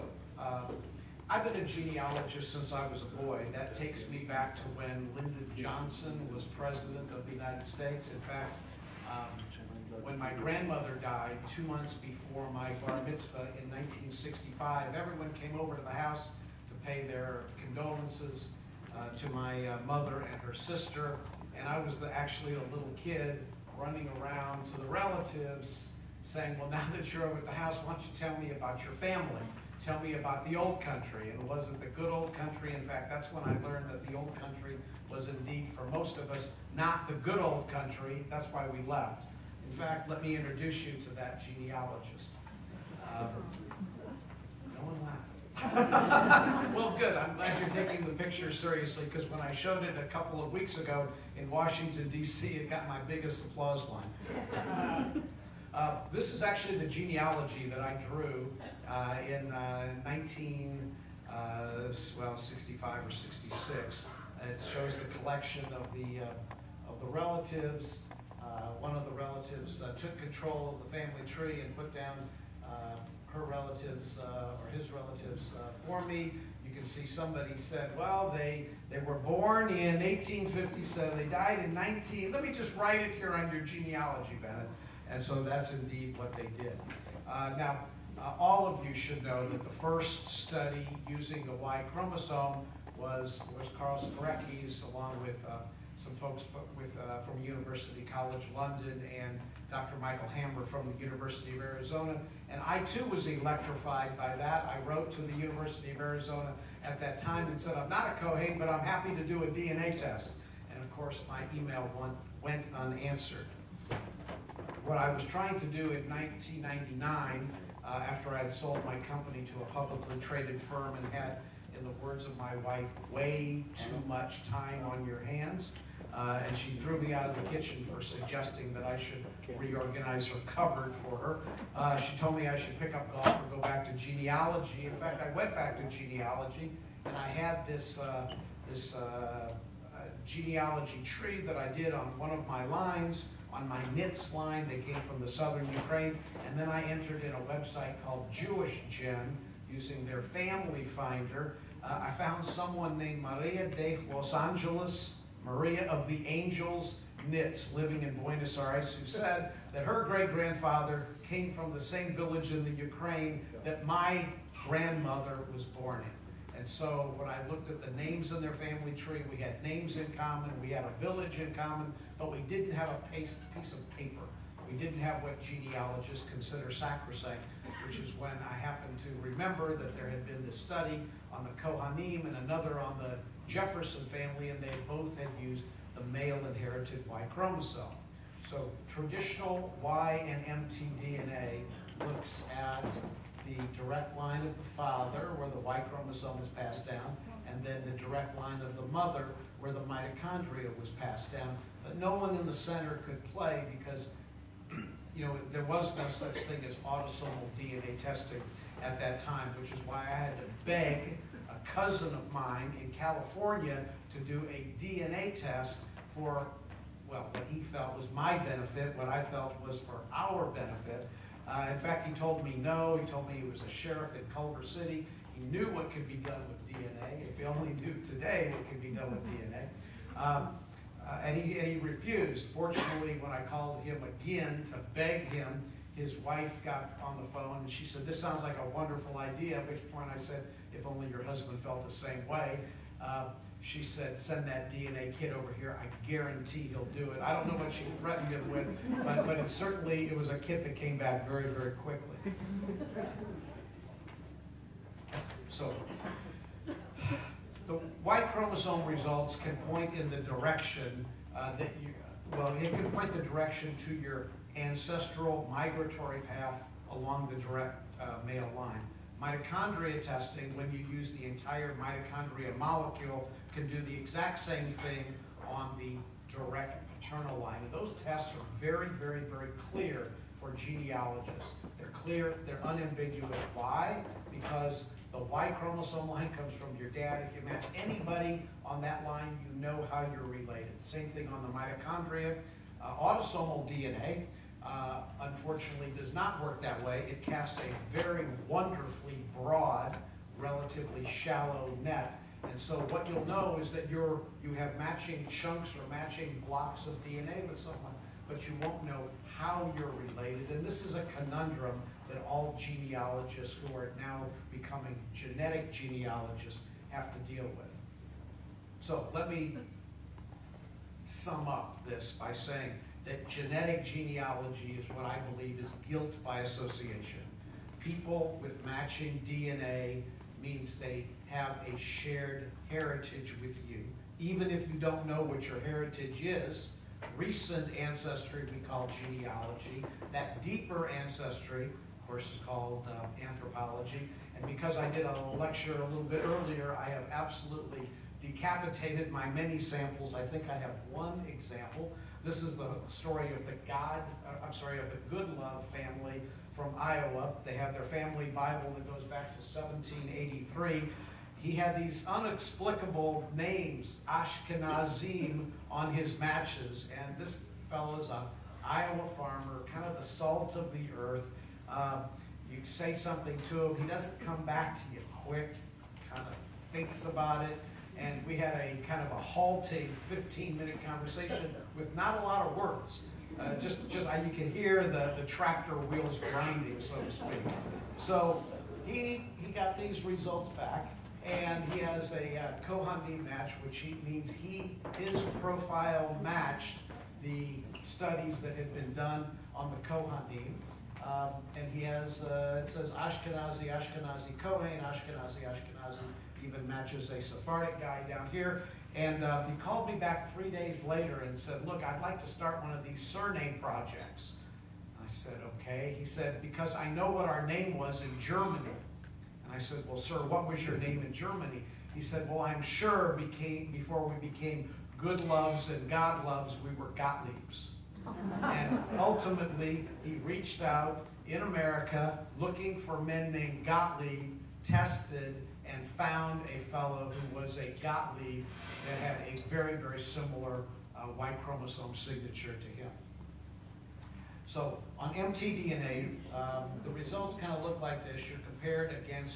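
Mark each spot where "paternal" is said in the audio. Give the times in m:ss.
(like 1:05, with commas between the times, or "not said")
4:36.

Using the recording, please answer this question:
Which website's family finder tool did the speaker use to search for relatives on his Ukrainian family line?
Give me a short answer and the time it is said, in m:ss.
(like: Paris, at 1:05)
Jewish Gen, at 2:28.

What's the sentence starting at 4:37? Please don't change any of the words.
And those tests are very, very, very clear for genealogists.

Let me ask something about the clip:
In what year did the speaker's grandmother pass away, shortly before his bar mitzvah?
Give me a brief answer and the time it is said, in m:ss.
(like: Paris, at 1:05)
1965, at 0:13.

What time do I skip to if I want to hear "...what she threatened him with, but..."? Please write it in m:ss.
4:07.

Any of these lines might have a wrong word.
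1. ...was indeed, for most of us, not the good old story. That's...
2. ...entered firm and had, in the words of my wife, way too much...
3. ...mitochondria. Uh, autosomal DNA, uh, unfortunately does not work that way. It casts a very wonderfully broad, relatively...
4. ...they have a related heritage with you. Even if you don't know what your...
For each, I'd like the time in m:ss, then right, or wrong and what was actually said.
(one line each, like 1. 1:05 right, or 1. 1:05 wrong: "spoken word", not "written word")
1. 0:35 wrong: "country", not "story"
2. 2:00 wrong: "traded", not "entered"
3. 4:51 right
4. 5:30 wrong: "shared", not "related".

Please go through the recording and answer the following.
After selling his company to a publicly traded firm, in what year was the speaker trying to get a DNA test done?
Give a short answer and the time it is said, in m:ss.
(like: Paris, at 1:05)
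1999, at 1:56.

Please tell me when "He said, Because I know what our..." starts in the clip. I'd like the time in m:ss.
6:55.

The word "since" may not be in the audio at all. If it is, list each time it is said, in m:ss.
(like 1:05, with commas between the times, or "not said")
0:02.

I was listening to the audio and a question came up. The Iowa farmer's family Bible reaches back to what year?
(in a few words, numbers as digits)
1783.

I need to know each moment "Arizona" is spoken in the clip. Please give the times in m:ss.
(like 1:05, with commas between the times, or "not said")
1:41, 1:45.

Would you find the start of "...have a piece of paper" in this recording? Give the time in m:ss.
2:52.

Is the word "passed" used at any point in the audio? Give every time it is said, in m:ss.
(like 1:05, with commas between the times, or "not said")
3:16, 3:20.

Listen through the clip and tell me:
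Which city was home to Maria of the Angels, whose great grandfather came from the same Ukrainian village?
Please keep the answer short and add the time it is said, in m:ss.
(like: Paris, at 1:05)
Buenos Aires, at 2:38.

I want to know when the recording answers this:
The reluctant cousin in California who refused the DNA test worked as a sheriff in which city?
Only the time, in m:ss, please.
3:44.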